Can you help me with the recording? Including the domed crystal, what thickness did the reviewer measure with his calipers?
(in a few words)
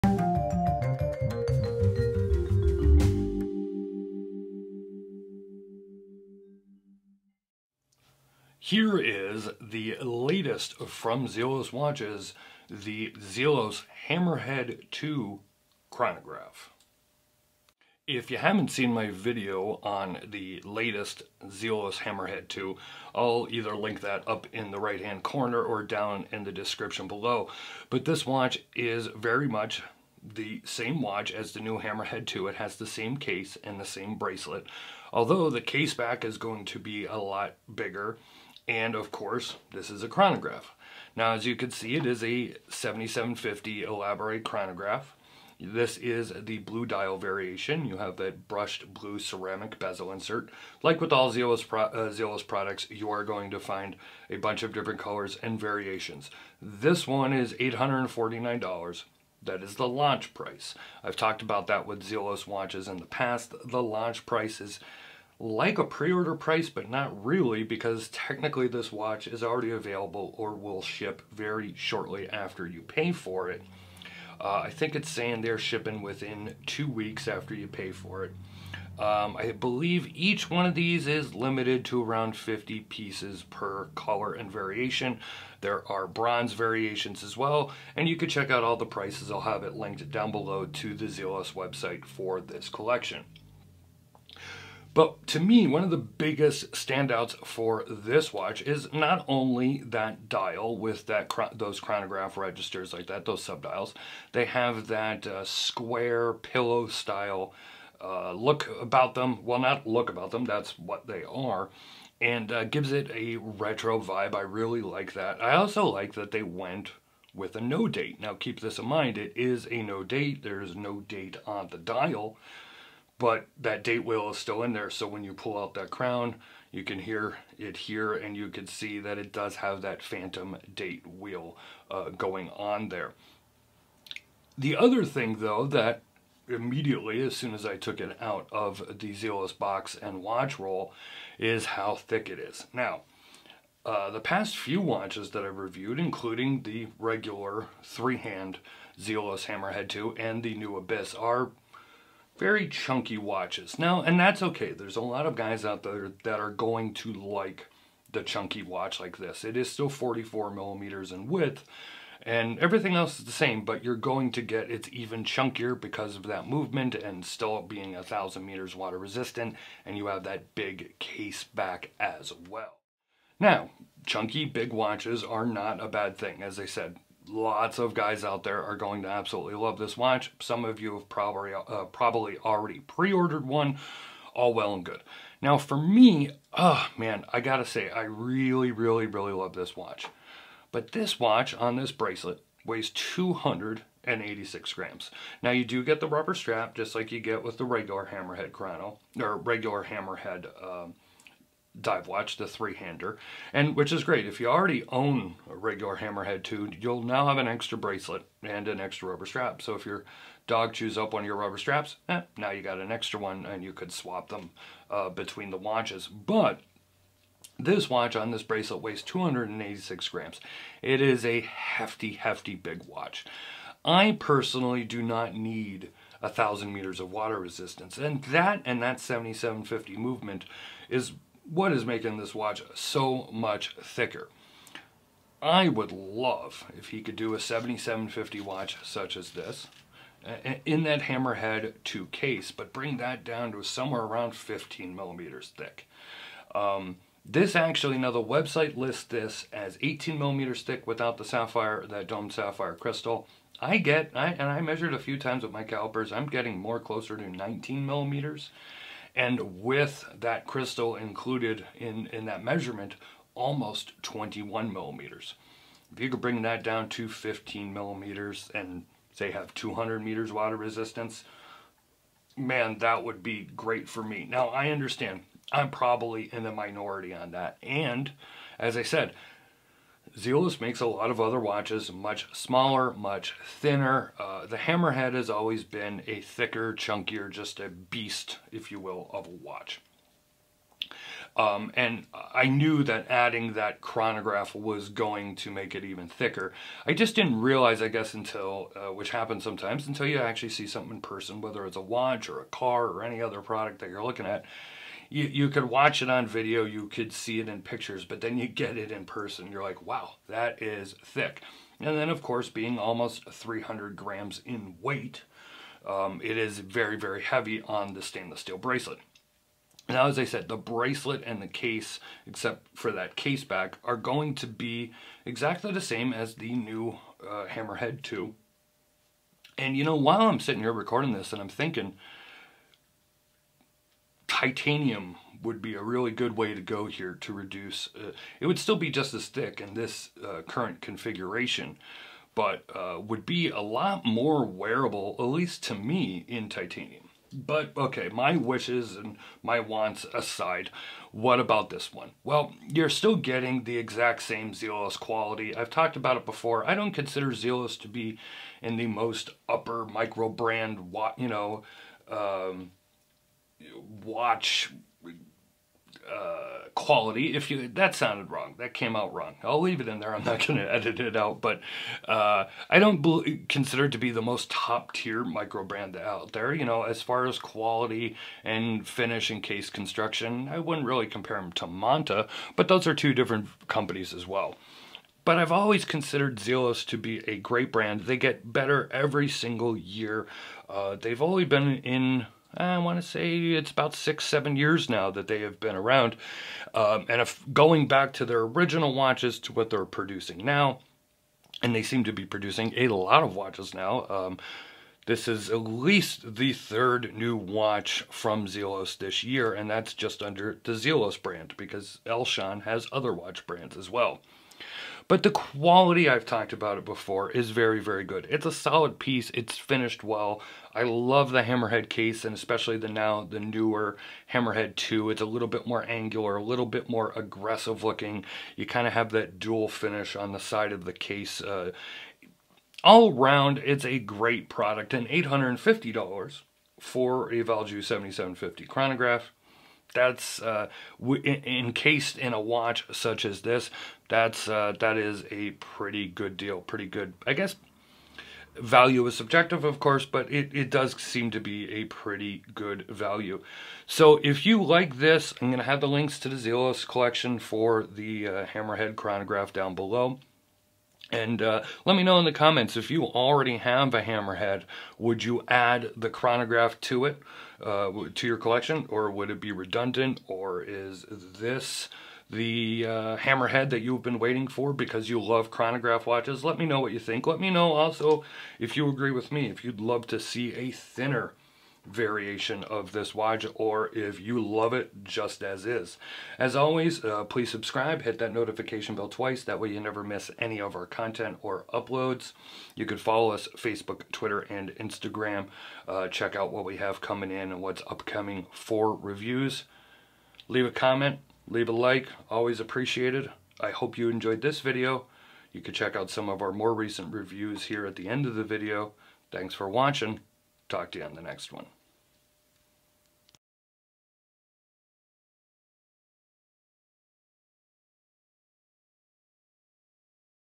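almost 21 millimeters.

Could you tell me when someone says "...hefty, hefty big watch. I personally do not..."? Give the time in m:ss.
3:41.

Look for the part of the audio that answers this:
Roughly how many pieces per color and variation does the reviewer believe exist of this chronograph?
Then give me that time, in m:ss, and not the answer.
1:22.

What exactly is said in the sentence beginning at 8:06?
As always, uh, please subscribe, hit that notification bell twice, that way you never miss any of our content or uploads.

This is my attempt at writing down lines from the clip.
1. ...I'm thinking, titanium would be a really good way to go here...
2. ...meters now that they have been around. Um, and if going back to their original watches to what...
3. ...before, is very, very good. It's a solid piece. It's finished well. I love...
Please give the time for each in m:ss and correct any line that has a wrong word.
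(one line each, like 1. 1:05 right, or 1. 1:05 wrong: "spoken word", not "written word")
1. 5:31 right
2. 6:34 wrong: "years", not "meters"
3. 6:56 right.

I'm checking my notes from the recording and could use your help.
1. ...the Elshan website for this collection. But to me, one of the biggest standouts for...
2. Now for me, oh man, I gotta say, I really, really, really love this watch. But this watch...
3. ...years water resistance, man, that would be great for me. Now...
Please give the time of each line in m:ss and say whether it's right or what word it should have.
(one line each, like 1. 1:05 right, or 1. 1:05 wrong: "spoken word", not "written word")
1. 1:30 wrong: "Zelos", not "Elshan"
2. 3:05 right
3. 4:30 wrong: "meters", not "years".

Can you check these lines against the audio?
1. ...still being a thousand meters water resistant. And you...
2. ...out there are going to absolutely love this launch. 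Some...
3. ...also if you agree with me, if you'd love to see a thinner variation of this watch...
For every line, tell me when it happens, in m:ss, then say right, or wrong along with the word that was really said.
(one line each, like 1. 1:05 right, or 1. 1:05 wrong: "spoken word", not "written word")
1. 2:47 right
2. 2:58 wrong: "watch", not "launch"
3. 7:57 right.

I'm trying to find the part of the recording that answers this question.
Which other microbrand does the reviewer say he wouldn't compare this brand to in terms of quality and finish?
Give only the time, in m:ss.
6:21.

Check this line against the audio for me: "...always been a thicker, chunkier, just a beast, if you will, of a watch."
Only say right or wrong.
right.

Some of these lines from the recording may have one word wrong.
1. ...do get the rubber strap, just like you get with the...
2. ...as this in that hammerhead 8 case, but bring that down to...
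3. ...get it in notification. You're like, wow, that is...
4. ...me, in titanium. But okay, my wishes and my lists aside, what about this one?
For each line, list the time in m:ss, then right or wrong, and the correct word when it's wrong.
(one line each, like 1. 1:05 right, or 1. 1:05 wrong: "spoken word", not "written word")
1. 3:15 right
2. 3:59 wrong: "2", not "8"
3. 5:08 wrong: "person", not "notification"
4. 5:45 wrong: "wants", not "lists".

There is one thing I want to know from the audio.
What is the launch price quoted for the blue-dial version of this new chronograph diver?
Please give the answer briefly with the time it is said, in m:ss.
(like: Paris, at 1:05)
$849, at 0:57.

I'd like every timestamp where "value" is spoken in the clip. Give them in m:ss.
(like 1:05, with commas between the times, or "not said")
7:28, 7:32.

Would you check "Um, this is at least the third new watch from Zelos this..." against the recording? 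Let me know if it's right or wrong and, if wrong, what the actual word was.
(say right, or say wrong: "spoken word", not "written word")
right.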